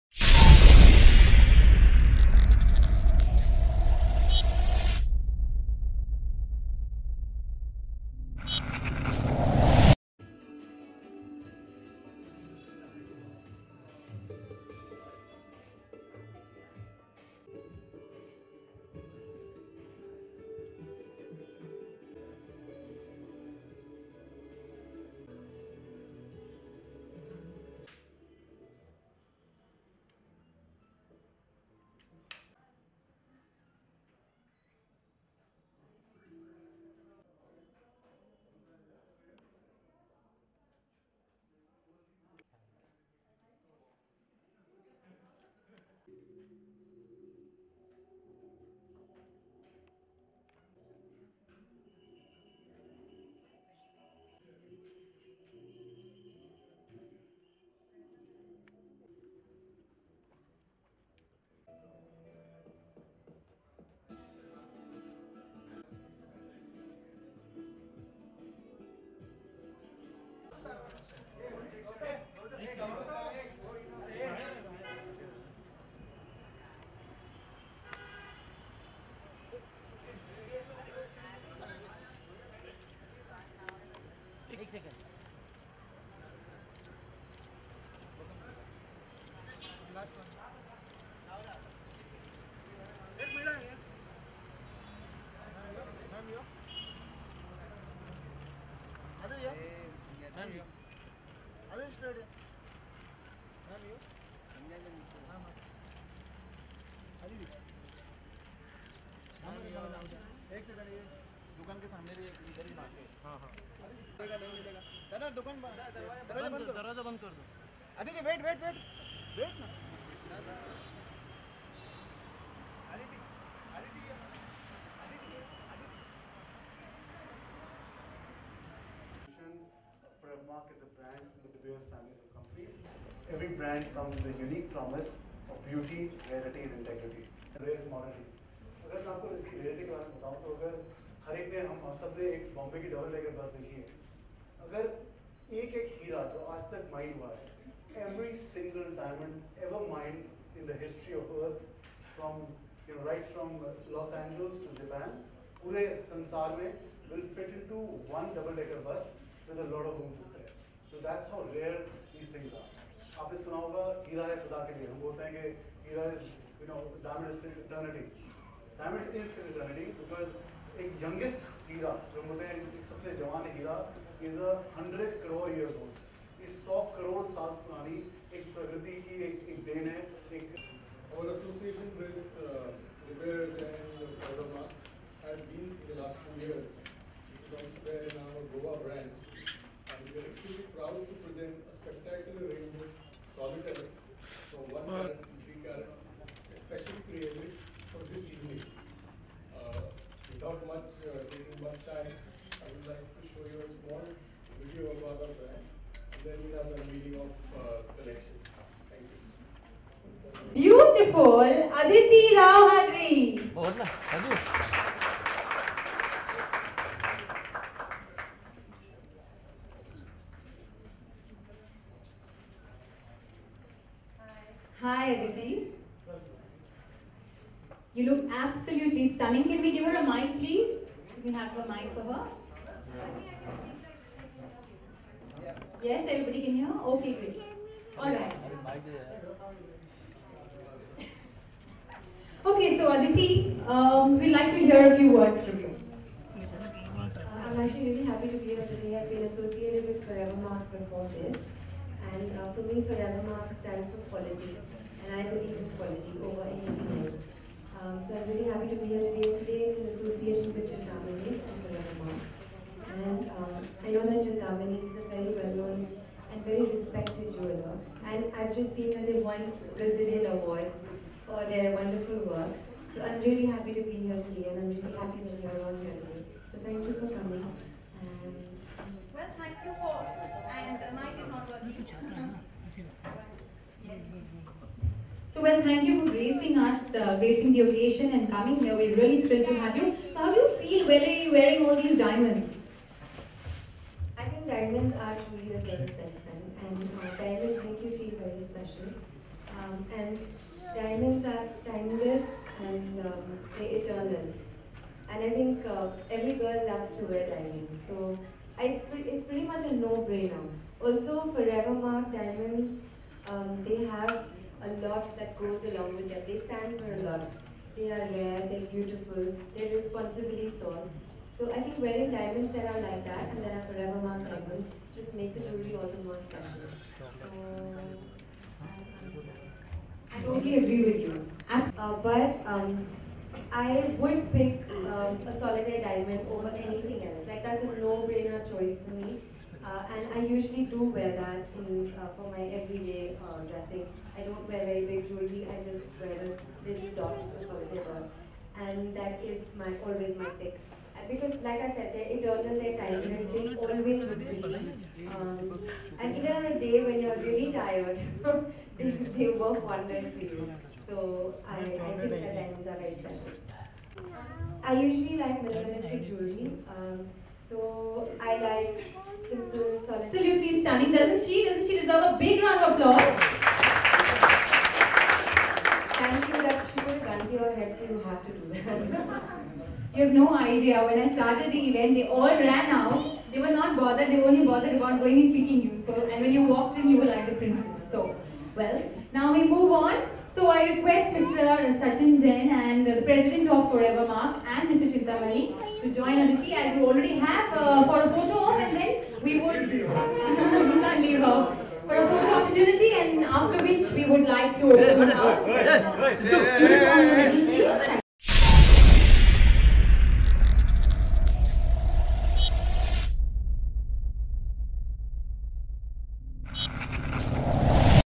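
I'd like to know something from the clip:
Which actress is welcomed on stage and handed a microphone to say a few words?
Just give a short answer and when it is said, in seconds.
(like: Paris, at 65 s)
Aditi Rao Hydari, at 211 s.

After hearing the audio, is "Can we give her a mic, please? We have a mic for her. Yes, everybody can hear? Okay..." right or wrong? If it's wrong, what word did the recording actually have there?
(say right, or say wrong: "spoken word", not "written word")
right.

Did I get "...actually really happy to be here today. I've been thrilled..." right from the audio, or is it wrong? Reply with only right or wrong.
wrong.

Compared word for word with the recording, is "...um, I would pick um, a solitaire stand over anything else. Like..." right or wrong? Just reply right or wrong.
wrong.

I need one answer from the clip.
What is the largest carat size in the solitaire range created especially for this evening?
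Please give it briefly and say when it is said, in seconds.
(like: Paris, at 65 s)
3 carat, at 195 s.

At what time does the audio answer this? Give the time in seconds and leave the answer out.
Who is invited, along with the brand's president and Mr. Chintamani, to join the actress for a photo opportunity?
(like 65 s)
391 s.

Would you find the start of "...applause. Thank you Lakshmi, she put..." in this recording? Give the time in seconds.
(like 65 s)
372 s.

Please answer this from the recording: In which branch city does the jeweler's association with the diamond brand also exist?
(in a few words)
Goa.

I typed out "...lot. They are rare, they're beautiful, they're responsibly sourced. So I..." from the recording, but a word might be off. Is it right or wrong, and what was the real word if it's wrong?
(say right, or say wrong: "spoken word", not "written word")
right.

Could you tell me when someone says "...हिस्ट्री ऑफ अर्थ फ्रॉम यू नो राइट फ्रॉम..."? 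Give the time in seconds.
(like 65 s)
150 s.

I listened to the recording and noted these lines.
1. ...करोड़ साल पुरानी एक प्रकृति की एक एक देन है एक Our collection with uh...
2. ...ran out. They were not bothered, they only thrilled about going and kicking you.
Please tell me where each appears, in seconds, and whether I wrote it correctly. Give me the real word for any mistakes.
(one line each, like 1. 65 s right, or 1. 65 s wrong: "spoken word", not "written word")
1. 176 s wrong: "association", not "collection"
2. 382 s wrong: "bothered", not "thrilled".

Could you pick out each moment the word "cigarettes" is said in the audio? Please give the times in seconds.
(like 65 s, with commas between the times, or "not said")
not said.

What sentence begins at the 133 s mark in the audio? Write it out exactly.
Every brand comes with a unique promise of beauty, rarity, and integrity.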